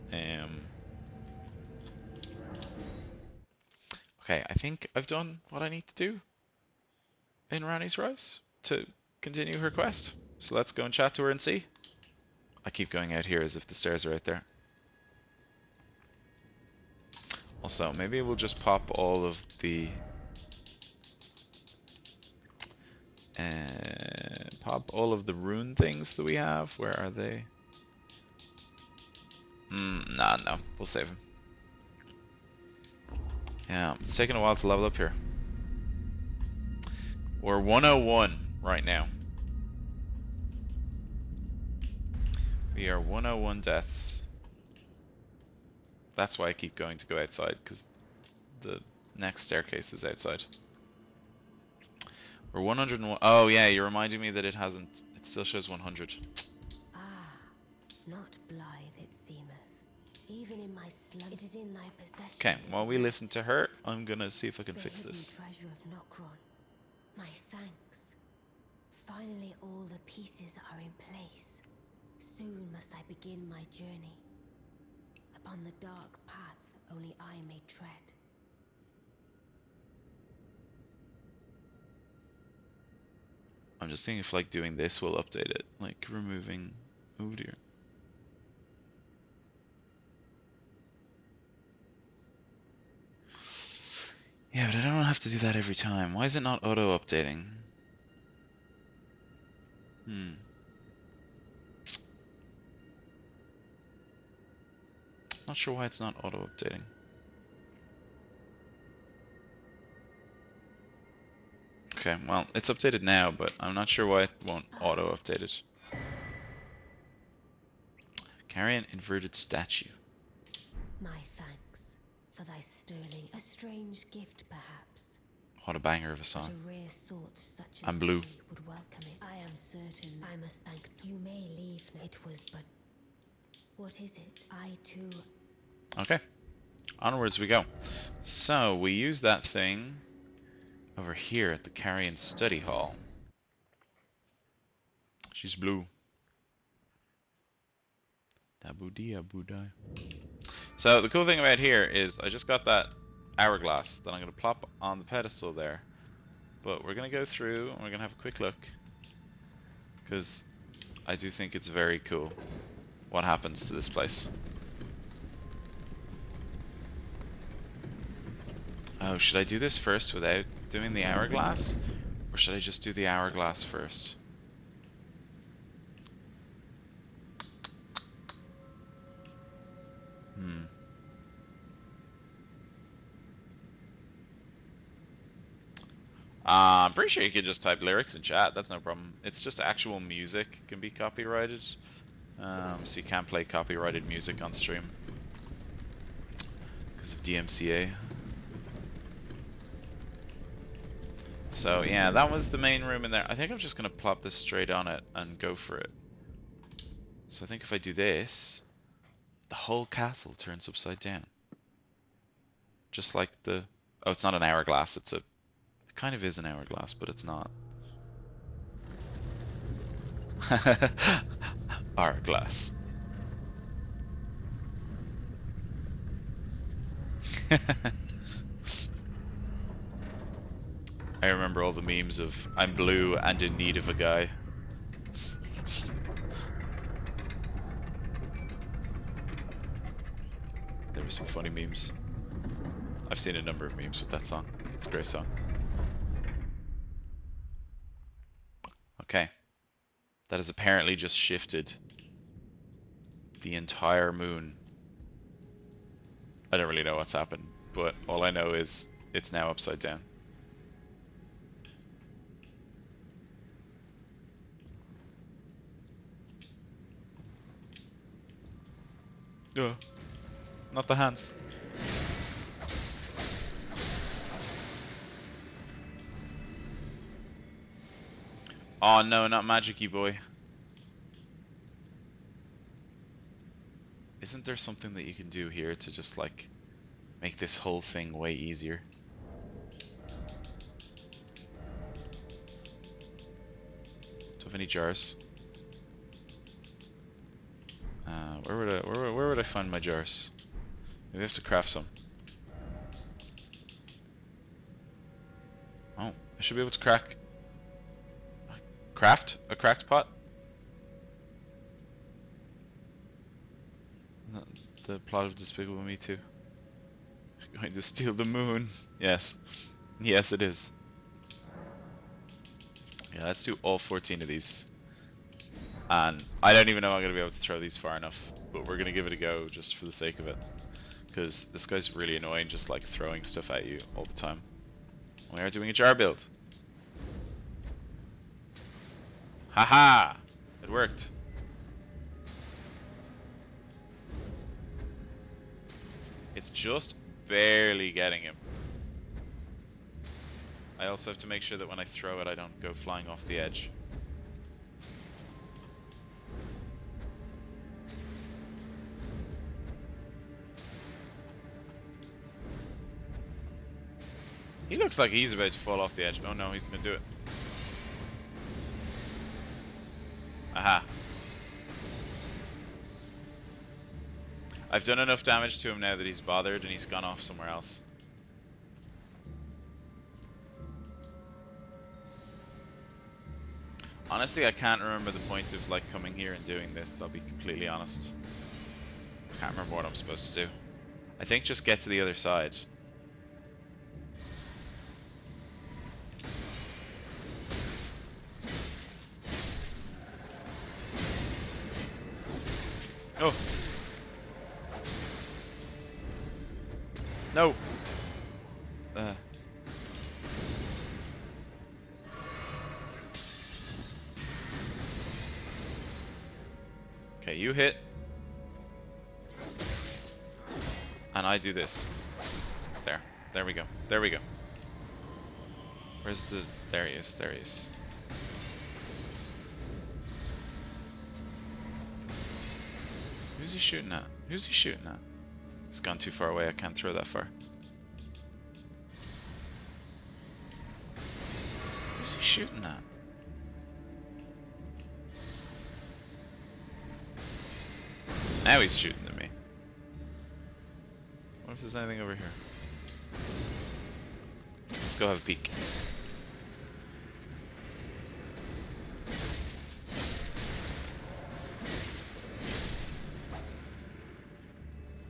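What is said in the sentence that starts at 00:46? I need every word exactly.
That's why I keep going to go outside, because the next staircase is outside.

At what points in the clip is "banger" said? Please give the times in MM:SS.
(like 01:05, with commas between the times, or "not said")
02:05.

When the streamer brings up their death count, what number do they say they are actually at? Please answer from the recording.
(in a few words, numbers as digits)
101.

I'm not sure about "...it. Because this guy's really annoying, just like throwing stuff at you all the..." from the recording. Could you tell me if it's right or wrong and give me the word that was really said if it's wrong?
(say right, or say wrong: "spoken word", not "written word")
right.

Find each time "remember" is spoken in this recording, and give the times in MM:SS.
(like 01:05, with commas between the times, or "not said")
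03:51, 06:24, 06:29.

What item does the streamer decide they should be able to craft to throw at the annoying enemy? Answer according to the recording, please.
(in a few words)
Cracked pot.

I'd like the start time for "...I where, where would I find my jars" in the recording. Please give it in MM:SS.
04:58.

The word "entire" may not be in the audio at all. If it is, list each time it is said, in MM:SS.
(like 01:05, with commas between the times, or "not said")
04:13.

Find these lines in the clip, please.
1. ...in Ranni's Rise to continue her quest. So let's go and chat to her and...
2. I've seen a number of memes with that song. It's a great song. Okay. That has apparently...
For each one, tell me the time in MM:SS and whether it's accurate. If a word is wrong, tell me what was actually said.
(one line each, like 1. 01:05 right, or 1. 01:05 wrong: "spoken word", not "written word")
1. 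00:07 right
2. 04:03 right.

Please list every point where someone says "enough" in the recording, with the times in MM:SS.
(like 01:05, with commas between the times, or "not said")
05:27, 06:14.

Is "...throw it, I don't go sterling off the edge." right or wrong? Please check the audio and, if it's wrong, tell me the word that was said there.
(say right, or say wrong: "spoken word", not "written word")
wrong: "flying", not "sterling".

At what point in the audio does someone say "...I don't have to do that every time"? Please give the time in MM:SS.
01:34.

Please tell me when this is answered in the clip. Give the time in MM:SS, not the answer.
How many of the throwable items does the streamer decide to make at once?
05:23.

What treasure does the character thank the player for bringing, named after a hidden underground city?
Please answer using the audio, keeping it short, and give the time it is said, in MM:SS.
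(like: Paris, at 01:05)
Treasure of Nokron, at 01:05.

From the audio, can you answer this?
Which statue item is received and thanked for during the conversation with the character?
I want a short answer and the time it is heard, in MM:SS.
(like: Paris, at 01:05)
Carian inverted statue, at 01:58.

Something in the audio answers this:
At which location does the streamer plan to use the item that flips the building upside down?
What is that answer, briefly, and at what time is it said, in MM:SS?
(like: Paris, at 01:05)
Carian Study Hall, at 02:21.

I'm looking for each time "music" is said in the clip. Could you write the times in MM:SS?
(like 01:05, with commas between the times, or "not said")
03:09, 03:14.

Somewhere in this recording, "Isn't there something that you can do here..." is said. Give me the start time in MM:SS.
04:44.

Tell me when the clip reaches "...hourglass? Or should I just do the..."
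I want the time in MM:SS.
02:51.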